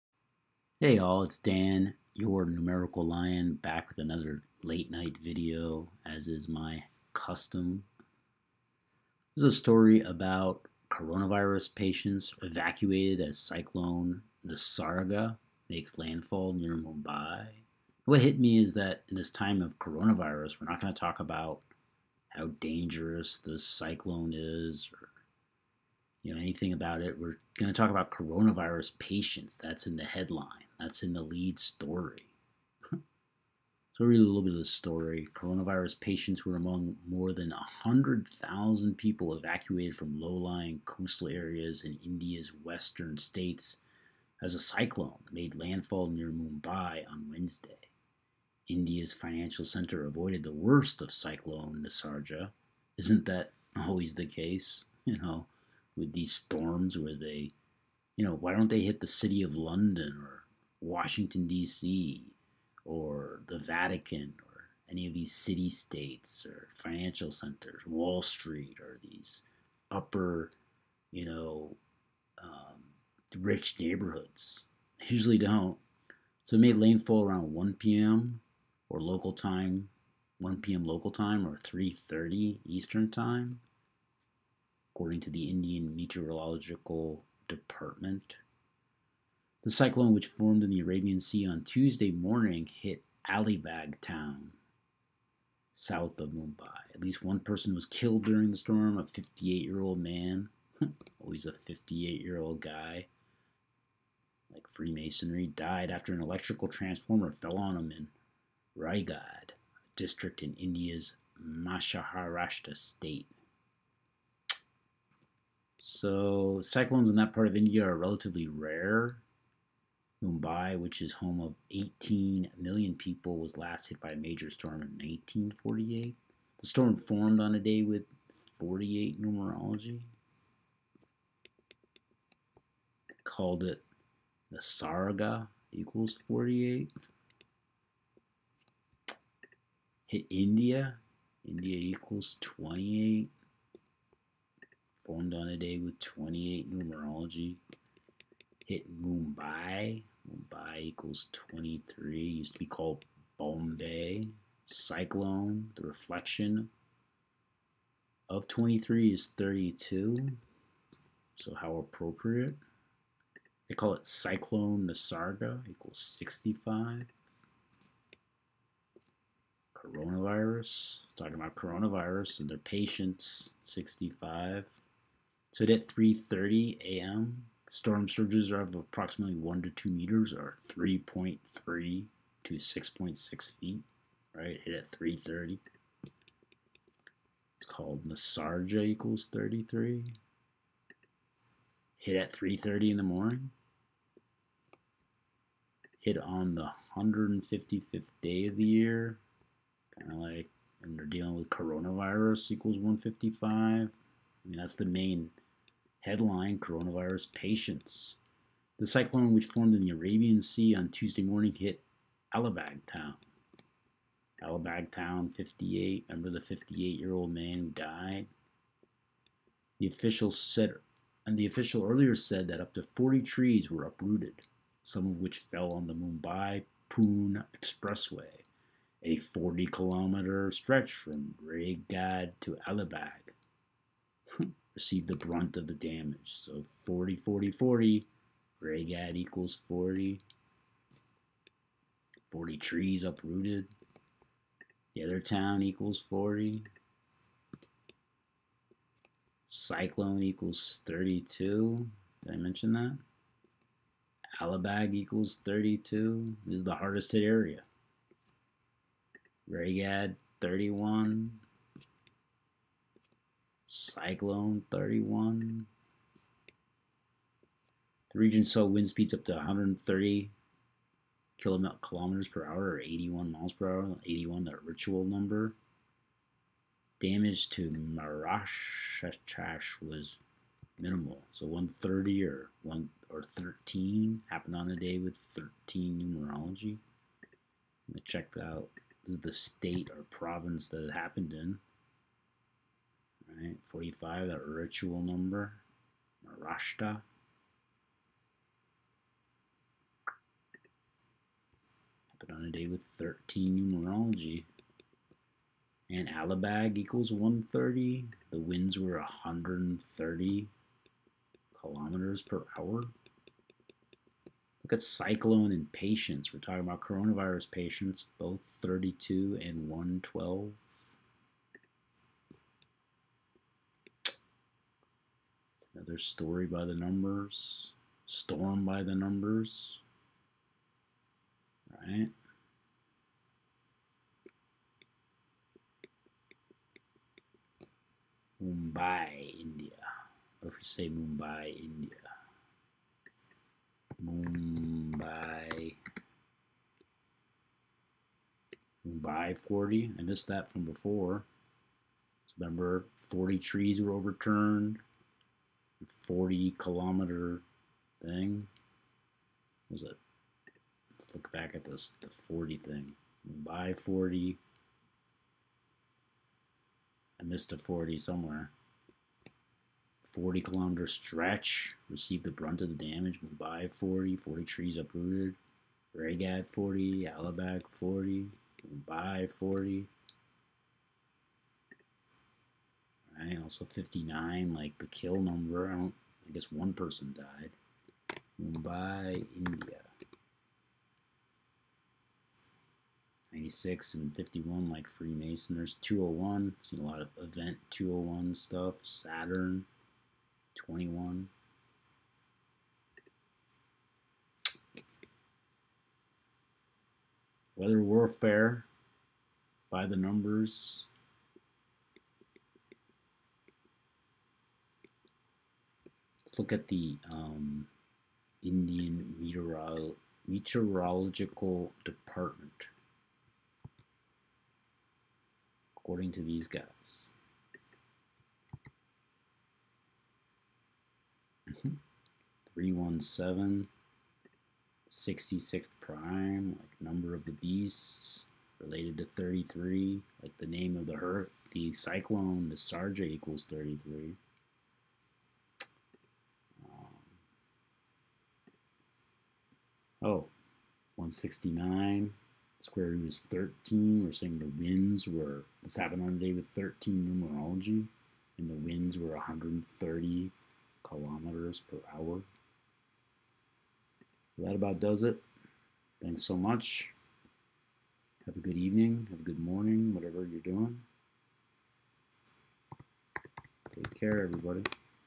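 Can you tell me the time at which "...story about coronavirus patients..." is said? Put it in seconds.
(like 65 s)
9 s.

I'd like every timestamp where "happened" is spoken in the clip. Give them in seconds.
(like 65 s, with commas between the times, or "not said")
284 s, 290 s, 302 s, 455 s.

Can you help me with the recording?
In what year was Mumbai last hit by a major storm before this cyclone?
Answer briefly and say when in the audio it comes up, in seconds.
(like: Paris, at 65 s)
1948, at 125 s.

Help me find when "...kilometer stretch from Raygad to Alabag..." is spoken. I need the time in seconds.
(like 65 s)
229 s.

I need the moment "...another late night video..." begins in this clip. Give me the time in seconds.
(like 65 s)
3 s.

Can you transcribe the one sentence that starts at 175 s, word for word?
So at 3.30 a.m., Storm surges are of approximately 1 to 2 meters or 3.3 to 6.6 feet, right?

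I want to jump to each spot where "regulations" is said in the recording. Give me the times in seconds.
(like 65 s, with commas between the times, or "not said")
not said.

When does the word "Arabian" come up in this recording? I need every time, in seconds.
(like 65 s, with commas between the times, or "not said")
90 s, 209 s.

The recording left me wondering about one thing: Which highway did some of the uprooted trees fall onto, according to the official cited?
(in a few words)
Mumbai Pune Expressway.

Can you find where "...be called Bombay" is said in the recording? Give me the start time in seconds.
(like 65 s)
152 s.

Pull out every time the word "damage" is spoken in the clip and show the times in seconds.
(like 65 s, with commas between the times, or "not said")
235 s, 276 s, 372 s.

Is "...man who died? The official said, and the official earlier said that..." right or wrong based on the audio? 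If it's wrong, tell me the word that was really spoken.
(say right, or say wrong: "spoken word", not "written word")
right.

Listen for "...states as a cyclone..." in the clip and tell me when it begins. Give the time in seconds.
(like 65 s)
43 s.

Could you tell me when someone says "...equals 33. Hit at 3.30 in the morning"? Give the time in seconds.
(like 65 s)
188 s.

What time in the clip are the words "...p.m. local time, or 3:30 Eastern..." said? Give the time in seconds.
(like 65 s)
80 s.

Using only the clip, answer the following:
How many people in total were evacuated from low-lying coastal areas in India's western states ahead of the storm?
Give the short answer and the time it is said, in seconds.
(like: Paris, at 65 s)
more than 100,000, at 37 s.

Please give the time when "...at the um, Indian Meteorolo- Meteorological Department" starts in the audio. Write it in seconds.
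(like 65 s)
416 s.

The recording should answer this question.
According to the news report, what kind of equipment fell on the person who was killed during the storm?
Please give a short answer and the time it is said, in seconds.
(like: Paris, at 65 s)
electrical transformer, at 106 s.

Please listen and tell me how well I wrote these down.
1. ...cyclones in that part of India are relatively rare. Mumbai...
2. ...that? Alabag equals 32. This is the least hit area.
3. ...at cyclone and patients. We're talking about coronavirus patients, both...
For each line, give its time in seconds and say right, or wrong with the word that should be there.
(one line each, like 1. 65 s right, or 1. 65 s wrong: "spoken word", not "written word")
1. 116 s right
2. 252 s wrong: "hardest", not "least"
3. 314 s right.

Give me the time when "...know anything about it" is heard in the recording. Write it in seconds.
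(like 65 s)
26 s.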